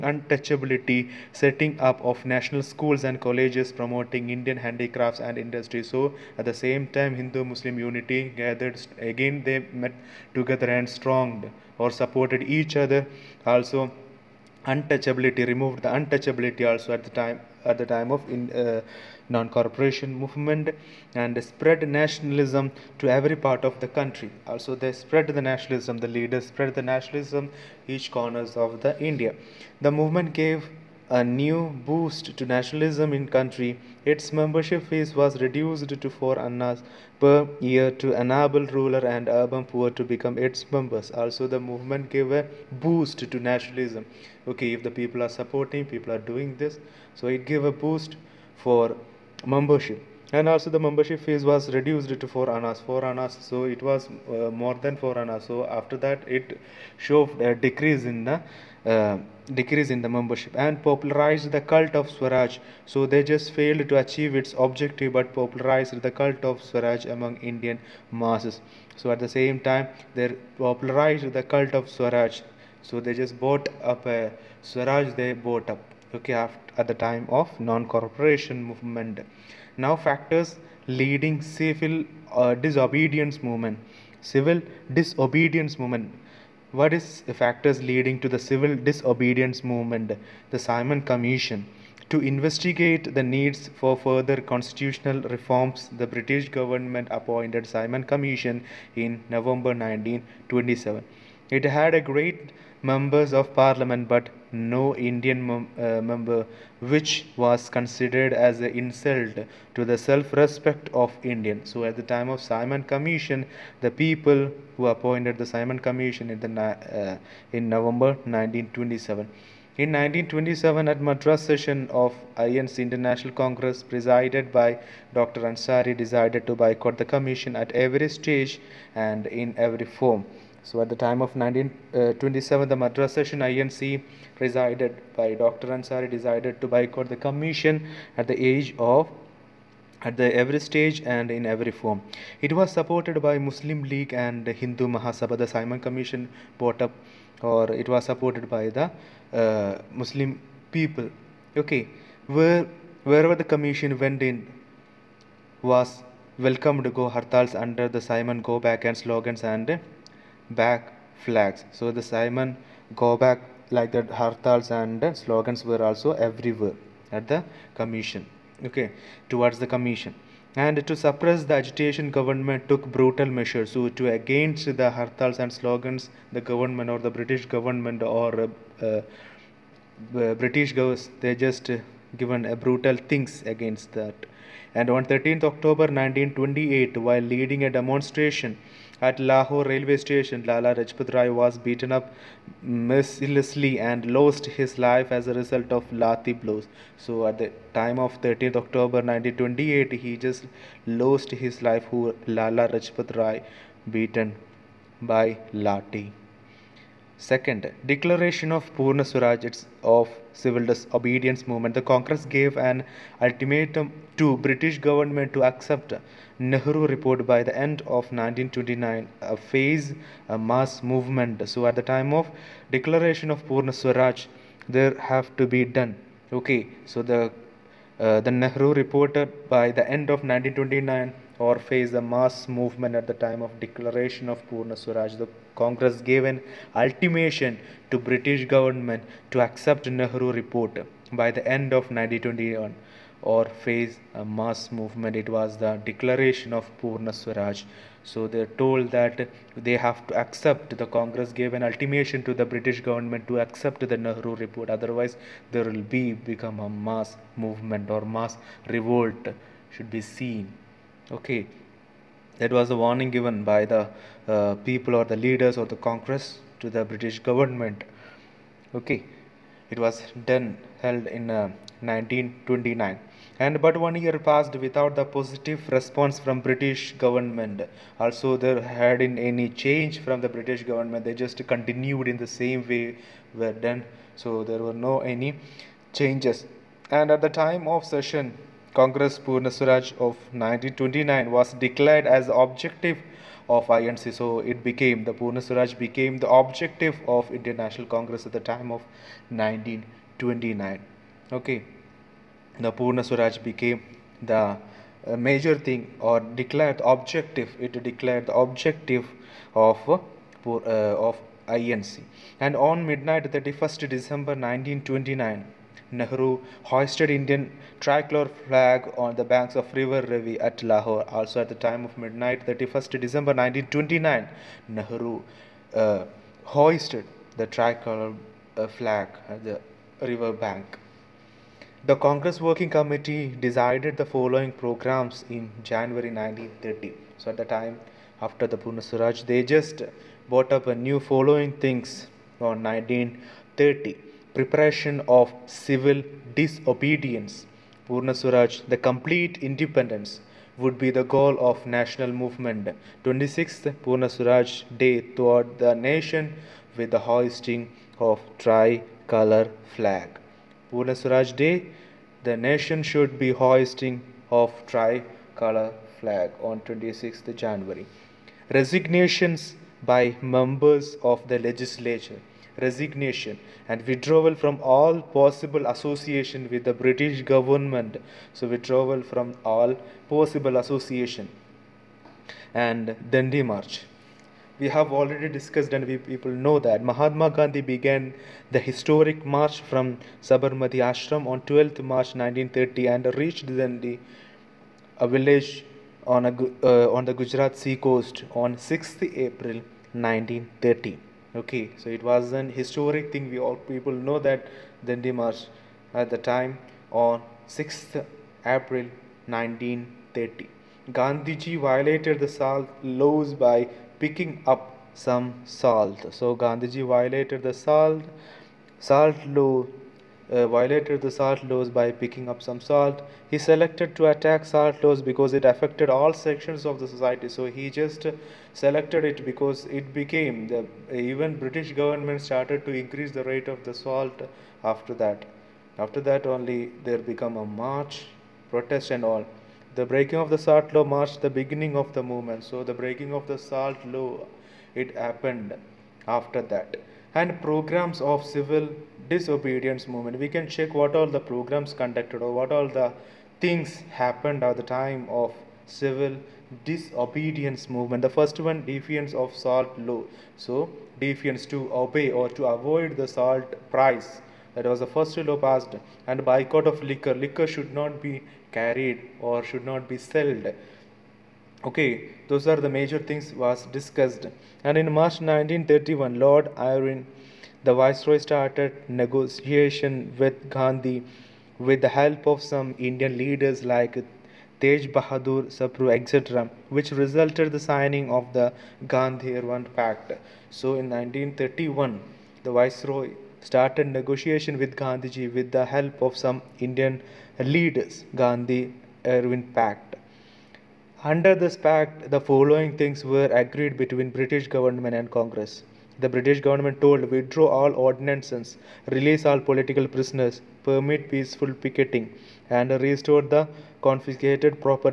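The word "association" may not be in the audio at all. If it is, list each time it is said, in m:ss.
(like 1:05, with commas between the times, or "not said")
6:15, 6:20.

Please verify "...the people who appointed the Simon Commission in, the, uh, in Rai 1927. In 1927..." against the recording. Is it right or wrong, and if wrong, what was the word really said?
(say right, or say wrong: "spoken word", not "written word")
wrong: "November", not "Rai".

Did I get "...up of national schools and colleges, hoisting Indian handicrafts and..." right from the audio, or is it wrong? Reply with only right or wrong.
wrong.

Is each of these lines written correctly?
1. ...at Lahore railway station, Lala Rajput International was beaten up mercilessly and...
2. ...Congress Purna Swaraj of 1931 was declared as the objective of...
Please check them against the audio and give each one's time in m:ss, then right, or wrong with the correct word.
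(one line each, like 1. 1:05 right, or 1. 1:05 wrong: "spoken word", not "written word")
1. 3:09 wrong: "Rai", not "International"
2. 4:48 wrong: "1929", not "1931".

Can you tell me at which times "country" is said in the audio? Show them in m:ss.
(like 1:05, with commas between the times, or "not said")
0:23, 0:33.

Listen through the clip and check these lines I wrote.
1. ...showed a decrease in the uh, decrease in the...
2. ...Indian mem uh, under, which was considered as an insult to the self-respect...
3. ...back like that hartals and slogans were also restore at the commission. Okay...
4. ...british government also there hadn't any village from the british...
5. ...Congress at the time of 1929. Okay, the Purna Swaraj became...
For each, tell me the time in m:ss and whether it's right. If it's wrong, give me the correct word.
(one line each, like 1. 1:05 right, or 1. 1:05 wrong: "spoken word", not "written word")
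1. 0:56 right
2. 1:44 wrong: "member", not "under"
3. 2:43 wrong: "everywhere", not "restore"
4. 4:36 wrong: "change", not "village"
5. 4:57 right.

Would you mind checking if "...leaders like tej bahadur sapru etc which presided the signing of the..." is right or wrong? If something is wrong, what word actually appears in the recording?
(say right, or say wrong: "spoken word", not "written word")
wrong: "resulted", not "presided".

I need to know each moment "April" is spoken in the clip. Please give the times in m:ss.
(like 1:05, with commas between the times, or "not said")
6:39, 6:48.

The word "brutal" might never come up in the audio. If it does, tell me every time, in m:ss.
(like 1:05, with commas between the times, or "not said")
2:52, 3:02.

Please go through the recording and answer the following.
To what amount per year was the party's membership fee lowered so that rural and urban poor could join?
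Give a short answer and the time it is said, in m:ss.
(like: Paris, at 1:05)
4 annas, at 0:36.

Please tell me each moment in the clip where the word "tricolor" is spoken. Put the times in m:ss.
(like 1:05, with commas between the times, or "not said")
5:17, 5:27, 5:58, 6:04.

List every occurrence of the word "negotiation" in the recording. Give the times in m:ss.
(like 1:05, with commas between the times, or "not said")
7:59, 8:14.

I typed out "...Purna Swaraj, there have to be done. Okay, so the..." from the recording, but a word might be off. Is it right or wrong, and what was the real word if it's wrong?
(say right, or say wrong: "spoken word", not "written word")
right.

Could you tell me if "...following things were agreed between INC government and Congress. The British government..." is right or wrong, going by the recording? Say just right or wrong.
wrong.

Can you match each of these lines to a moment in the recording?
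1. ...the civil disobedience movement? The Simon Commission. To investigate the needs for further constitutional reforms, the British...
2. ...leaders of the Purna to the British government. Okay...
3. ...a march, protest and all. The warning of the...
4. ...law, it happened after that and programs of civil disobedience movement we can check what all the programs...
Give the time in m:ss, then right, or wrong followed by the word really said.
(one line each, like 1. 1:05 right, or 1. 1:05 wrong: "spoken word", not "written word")
1. 1:28 right
2. 4:25 wrong: "Congress", not "Purna"
3. 7:17 wrong: "breaking", not "warning"
4. 7:23 right.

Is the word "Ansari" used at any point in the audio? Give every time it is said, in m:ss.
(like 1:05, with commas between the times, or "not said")
2:05, 2:15.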